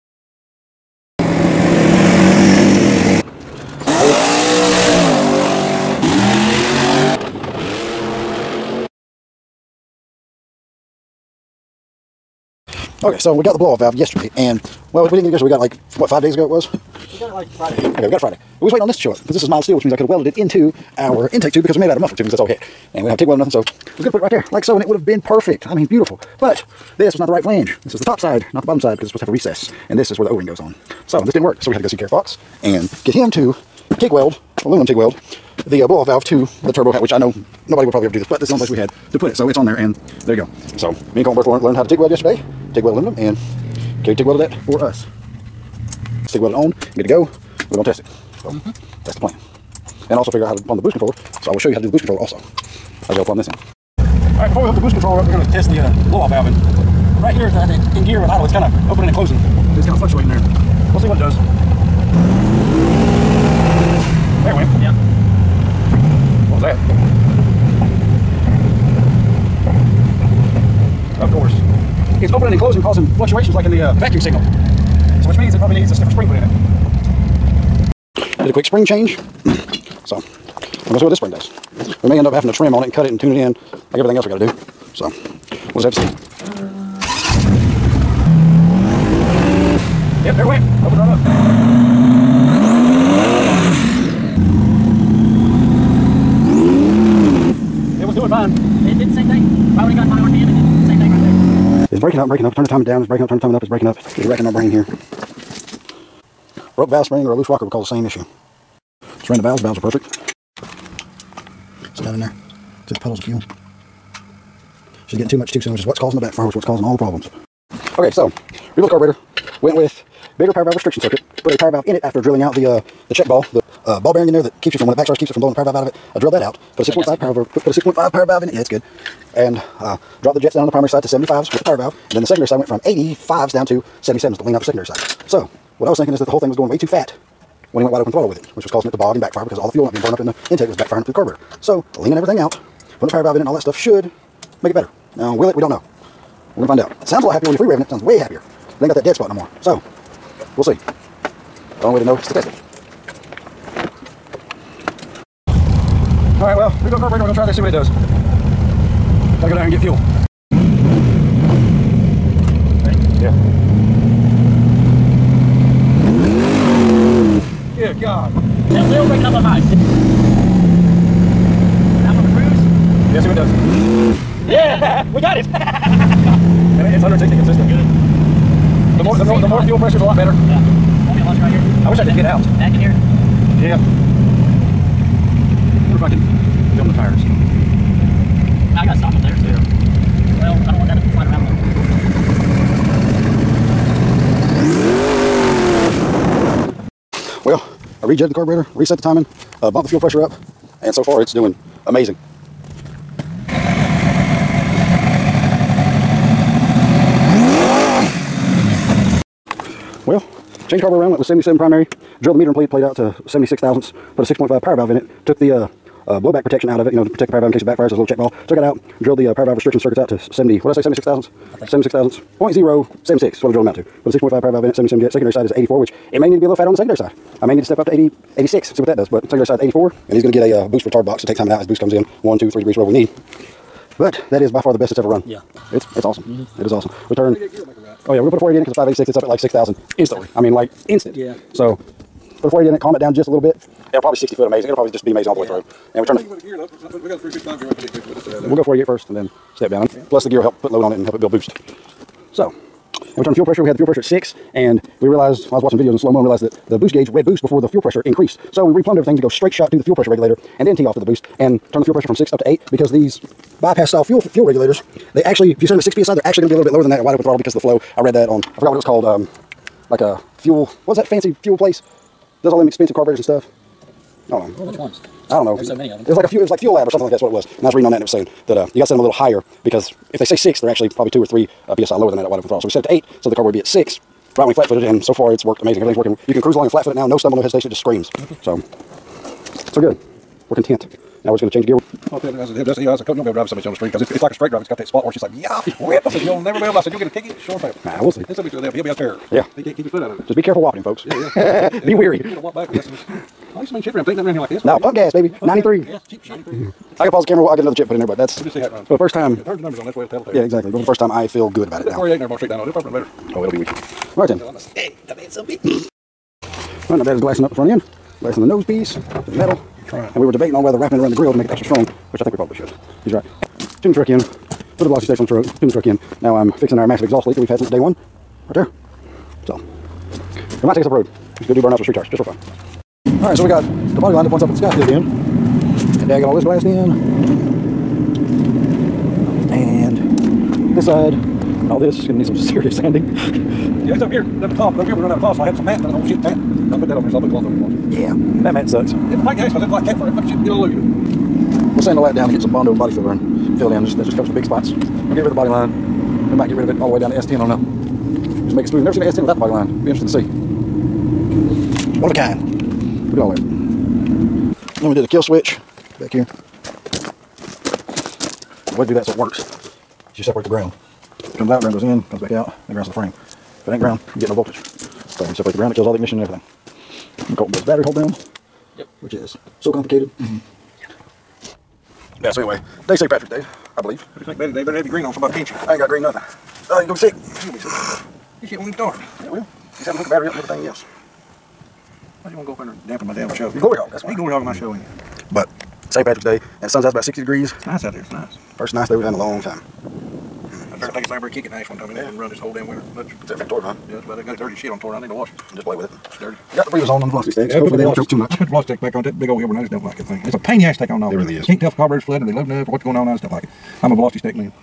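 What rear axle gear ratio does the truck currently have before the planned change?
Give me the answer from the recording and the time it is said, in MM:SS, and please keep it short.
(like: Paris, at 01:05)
355, at 04:07.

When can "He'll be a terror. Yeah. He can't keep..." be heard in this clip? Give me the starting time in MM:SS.
04:58.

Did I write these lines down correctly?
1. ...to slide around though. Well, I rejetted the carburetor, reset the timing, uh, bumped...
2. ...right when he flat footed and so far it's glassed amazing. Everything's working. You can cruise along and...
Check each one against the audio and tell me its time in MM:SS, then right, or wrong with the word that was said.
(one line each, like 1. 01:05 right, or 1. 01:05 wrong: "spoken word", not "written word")
1. 03:10 right
2. 04:44 wrong: "worked", not "glassed".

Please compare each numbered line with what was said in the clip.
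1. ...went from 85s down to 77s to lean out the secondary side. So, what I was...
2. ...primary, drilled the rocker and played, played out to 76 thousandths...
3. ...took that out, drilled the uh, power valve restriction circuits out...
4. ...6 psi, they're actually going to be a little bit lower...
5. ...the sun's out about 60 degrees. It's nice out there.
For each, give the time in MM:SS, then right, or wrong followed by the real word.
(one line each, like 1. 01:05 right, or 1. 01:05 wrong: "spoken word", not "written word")
1. 02:12 right
2. 03:31 wrong: "meter", not "rocker"
3. 03:38 right
4. 04:25 right
5. 06:36 right.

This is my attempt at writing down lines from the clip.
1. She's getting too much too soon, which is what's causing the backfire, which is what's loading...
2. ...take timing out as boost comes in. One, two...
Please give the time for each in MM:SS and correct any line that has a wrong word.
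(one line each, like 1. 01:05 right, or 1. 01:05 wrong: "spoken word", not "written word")
1. 01:55 wrong: "causing", not "loading"
2. 03:51 right.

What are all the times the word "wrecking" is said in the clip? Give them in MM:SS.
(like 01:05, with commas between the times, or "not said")
01:44.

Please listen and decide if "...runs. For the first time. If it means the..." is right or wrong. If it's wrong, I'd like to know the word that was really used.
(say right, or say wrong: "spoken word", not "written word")
wrong: "turns", not "means".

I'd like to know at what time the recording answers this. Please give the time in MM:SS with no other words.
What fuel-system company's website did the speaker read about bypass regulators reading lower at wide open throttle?
04:36.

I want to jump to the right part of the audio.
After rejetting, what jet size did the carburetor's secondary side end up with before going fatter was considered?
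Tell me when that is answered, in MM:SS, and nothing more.
03:45.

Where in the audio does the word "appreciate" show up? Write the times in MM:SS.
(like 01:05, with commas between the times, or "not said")
not said.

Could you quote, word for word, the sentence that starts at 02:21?
So, leaning everything out, putting a power valve in it and all that stuff should make it better.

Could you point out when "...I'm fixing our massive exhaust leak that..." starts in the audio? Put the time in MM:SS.
05:26.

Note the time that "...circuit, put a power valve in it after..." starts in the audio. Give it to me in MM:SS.
02:00.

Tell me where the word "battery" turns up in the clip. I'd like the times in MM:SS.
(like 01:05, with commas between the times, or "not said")
06:17, 06:30.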